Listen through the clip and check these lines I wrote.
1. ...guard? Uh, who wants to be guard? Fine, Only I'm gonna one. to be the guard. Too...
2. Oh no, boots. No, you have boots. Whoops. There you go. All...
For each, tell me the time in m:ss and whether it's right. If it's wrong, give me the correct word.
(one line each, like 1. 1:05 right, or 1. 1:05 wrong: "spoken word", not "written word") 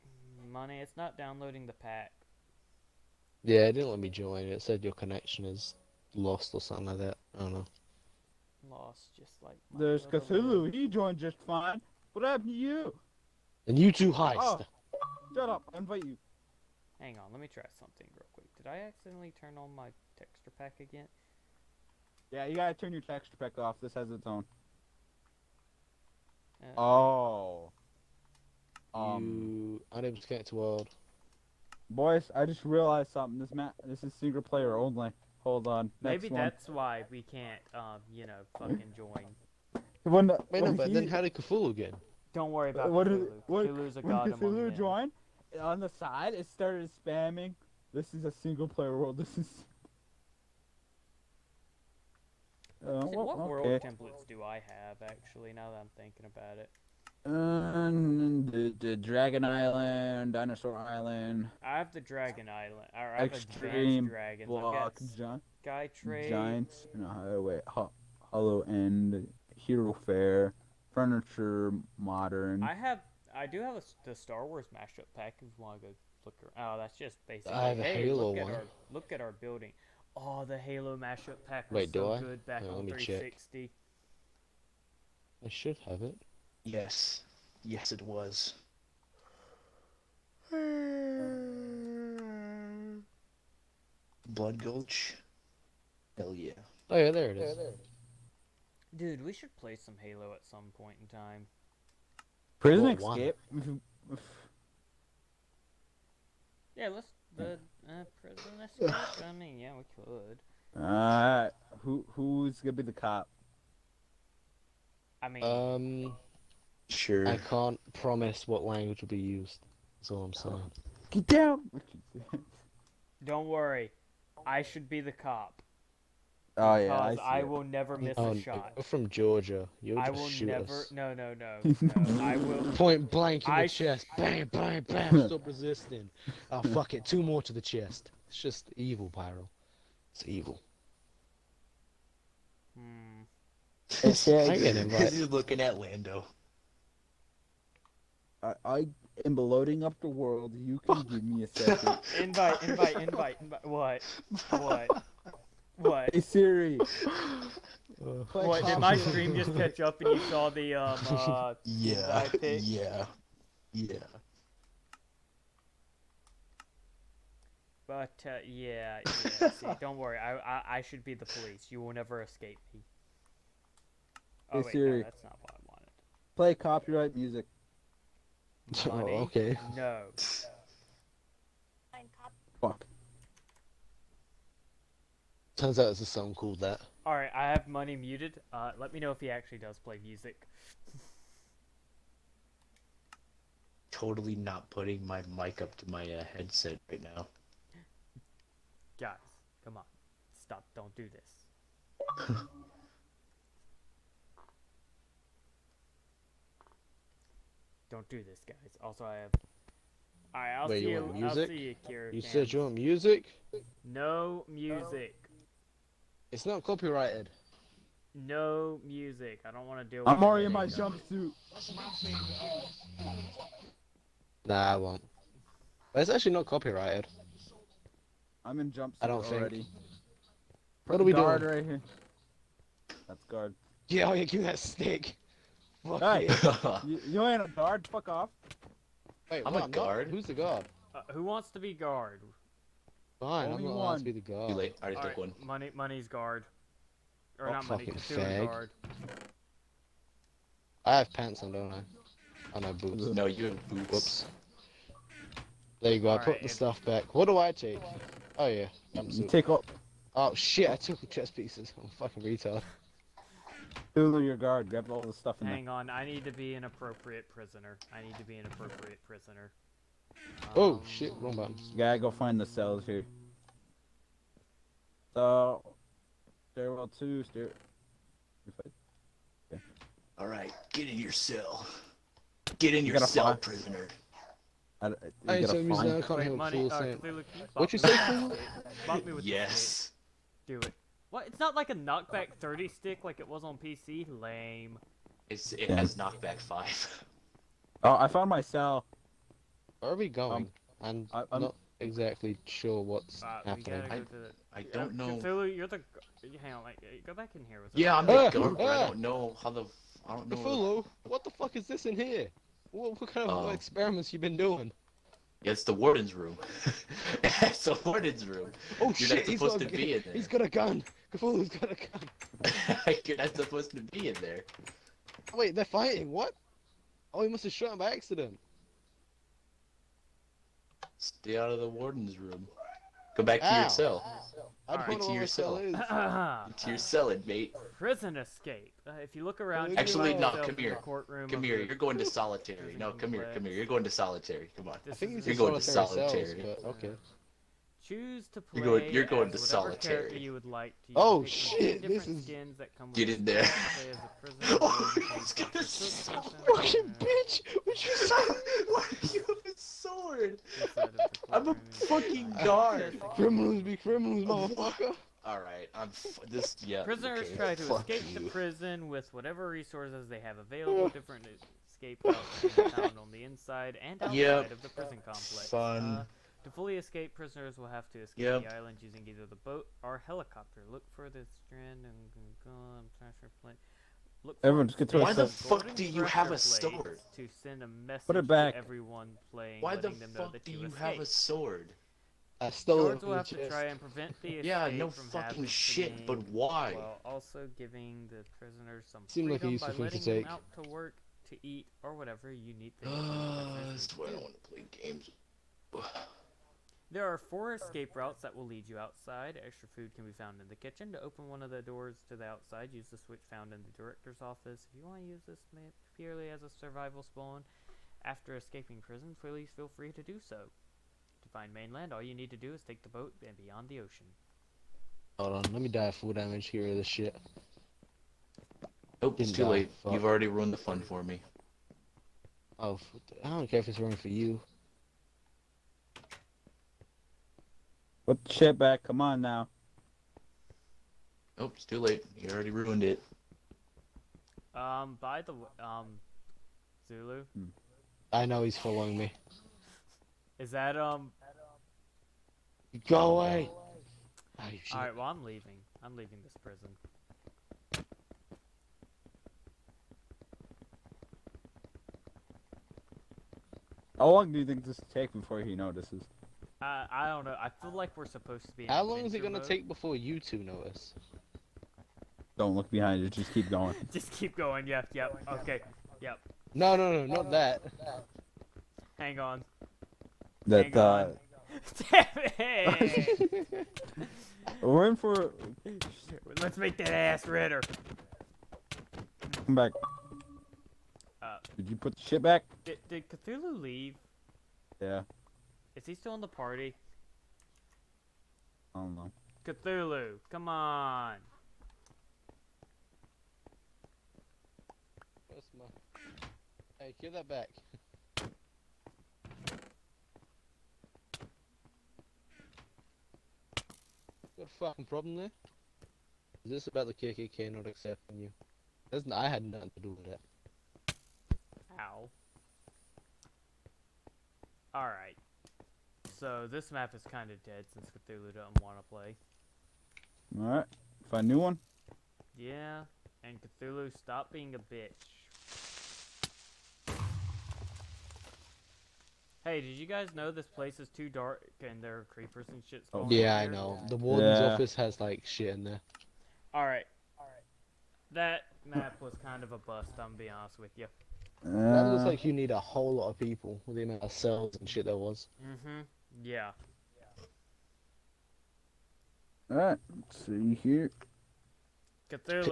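1. 4:00 right
2. 4:12 right.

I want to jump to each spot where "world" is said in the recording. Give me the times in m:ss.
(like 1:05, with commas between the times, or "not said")
0:30, 0:48, 0:53, 2:30.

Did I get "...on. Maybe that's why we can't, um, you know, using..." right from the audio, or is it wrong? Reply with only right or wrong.
wrong.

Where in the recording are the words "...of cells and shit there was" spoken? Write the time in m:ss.
9:14.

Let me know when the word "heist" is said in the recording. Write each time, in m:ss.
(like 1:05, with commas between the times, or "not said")
0:14.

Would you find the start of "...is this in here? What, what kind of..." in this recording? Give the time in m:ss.
5:11.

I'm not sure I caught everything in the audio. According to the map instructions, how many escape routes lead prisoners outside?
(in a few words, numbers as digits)
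4.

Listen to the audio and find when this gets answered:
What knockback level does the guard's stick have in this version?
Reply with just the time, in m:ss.
4:55.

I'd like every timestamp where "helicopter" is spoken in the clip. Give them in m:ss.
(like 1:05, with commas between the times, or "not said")
6:20.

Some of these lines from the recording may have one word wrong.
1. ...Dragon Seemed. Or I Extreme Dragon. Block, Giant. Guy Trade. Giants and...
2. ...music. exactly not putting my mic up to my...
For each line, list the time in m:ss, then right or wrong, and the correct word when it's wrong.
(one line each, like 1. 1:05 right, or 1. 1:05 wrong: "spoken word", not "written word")
1. 1:02 wrong: "Island", not "Seemed"
2. 3:10 wrong: "totally", not "exactly".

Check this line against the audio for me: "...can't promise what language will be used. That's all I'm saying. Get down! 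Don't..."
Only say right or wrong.
right.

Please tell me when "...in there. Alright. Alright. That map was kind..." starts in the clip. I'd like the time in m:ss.
9:05.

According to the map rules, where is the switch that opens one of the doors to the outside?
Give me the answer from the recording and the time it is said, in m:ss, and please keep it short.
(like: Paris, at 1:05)
Director's office, at 6:53.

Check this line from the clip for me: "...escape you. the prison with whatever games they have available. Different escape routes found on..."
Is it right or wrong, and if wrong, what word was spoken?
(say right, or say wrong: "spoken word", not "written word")
wrong: "resources", not "games".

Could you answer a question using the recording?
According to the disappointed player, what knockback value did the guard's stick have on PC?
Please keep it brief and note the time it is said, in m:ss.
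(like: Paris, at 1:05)
30, at 4:51.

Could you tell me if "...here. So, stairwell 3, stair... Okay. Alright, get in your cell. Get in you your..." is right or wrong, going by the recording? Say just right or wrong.
wrong.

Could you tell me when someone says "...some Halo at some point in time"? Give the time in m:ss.
1:39.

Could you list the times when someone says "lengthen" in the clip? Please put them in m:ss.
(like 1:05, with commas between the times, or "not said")
not said.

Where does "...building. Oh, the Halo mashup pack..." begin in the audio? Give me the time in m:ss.
1:19.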